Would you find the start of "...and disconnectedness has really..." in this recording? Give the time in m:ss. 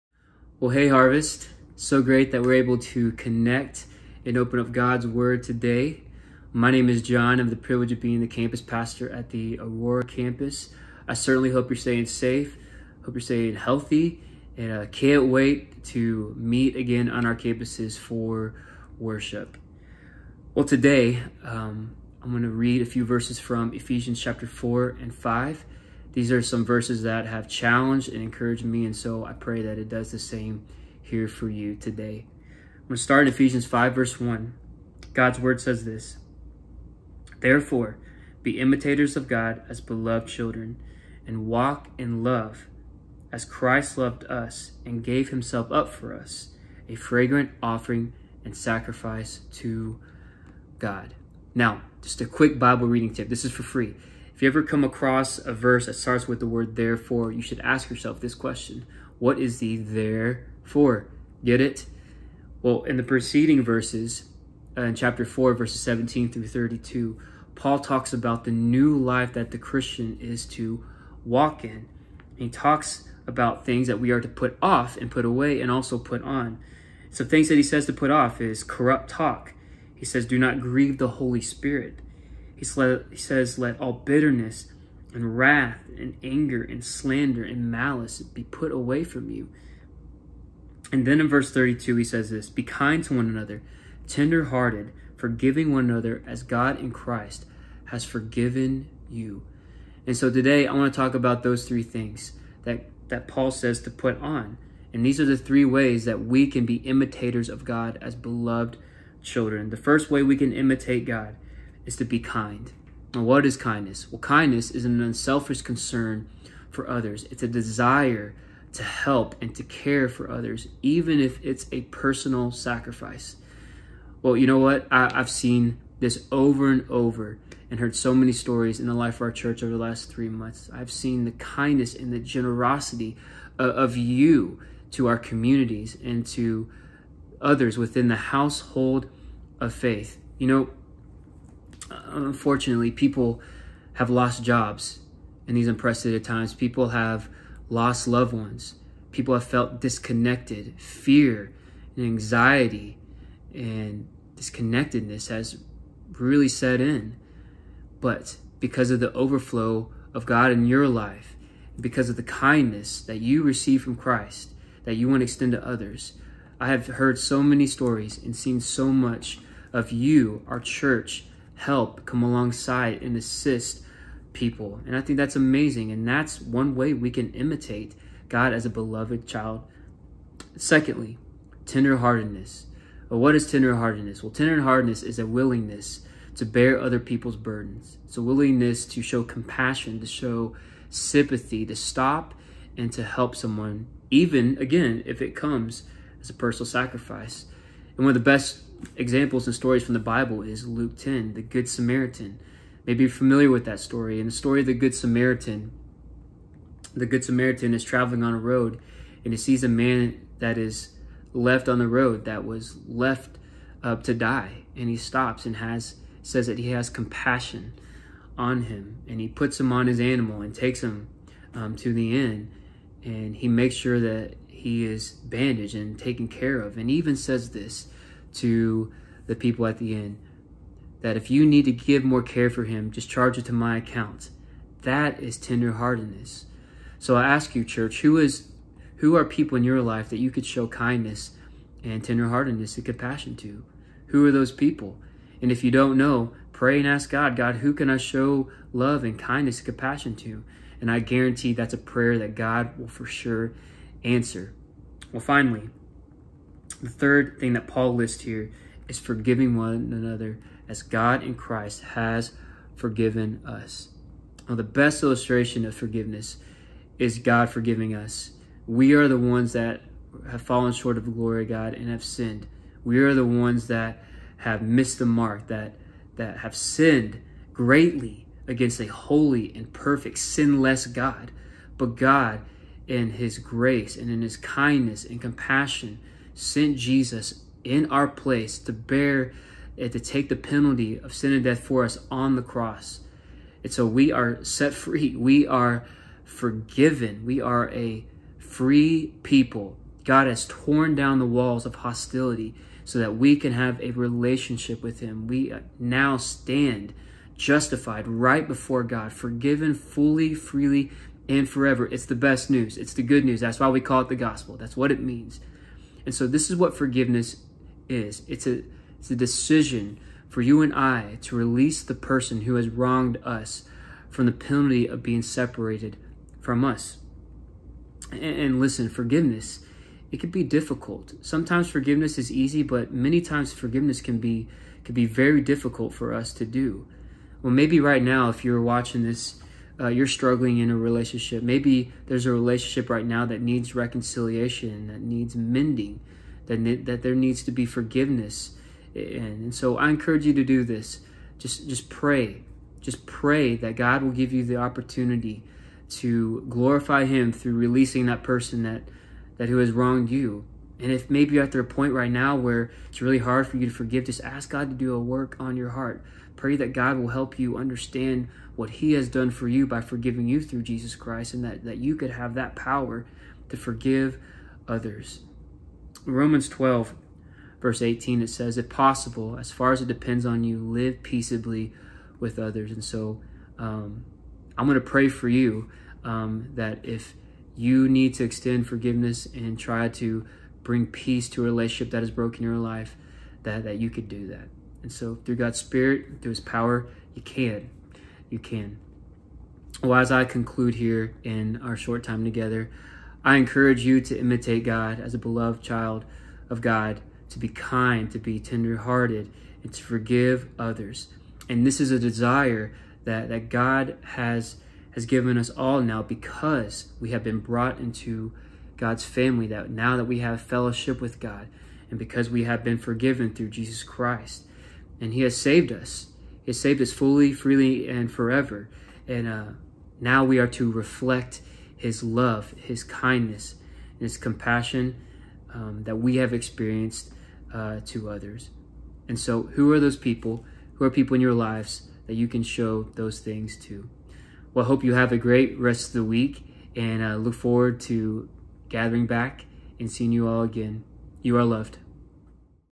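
2:33.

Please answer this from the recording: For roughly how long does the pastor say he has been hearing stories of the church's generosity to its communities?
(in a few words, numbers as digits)
three months.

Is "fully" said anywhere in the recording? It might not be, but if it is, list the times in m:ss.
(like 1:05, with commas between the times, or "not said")
5:09, 7:06.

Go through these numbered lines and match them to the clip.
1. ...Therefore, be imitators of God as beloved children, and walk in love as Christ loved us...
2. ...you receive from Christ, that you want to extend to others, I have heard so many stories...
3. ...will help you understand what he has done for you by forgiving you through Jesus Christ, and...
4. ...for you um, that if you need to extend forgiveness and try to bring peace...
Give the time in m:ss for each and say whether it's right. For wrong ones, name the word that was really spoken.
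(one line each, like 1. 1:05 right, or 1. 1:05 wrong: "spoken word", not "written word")
1. 0:37 right
2. 2:43 right
3. 6:06 right
4. 6:25 right.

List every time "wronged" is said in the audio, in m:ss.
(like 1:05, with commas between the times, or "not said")
5:22, 5:59.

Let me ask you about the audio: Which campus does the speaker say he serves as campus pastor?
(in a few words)
Aurora.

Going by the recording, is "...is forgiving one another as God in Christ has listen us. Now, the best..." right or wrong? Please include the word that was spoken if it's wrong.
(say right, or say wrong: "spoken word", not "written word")
wrong: "forgiven", not "listen".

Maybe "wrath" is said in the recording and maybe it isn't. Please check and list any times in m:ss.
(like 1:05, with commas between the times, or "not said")
1:25.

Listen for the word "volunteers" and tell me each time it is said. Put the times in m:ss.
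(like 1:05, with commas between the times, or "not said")
not said.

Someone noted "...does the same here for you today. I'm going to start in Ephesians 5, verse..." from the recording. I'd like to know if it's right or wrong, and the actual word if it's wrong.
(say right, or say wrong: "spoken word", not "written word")
right.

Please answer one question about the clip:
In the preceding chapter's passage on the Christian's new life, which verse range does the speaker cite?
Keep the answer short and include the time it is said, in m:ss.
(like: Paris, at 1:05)
17 through 32, at 1:05.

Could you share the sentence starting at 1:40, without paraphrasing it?
And so today I want to talk about those three things that, that Paul says to put on.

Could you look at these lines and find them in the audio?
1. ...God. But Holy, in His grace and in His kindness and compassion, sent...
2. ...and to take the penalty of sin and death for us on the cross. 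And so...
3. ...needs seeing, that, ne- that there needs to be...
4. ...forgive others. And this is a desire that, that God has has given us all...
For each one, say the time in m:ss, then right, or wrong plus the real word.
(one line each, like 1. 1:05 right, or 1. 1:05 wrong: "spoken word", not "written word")
1. 4:40 wrong: "God", not "Holy"
2. 4:49 right
3. 5:45 wrong: "mending", not "seeing"
4. 6:49 right.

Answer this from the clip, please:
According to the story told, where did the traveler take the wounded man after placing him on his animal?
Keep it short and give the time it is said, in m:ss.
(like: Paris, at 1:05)
the inn, at 3:41.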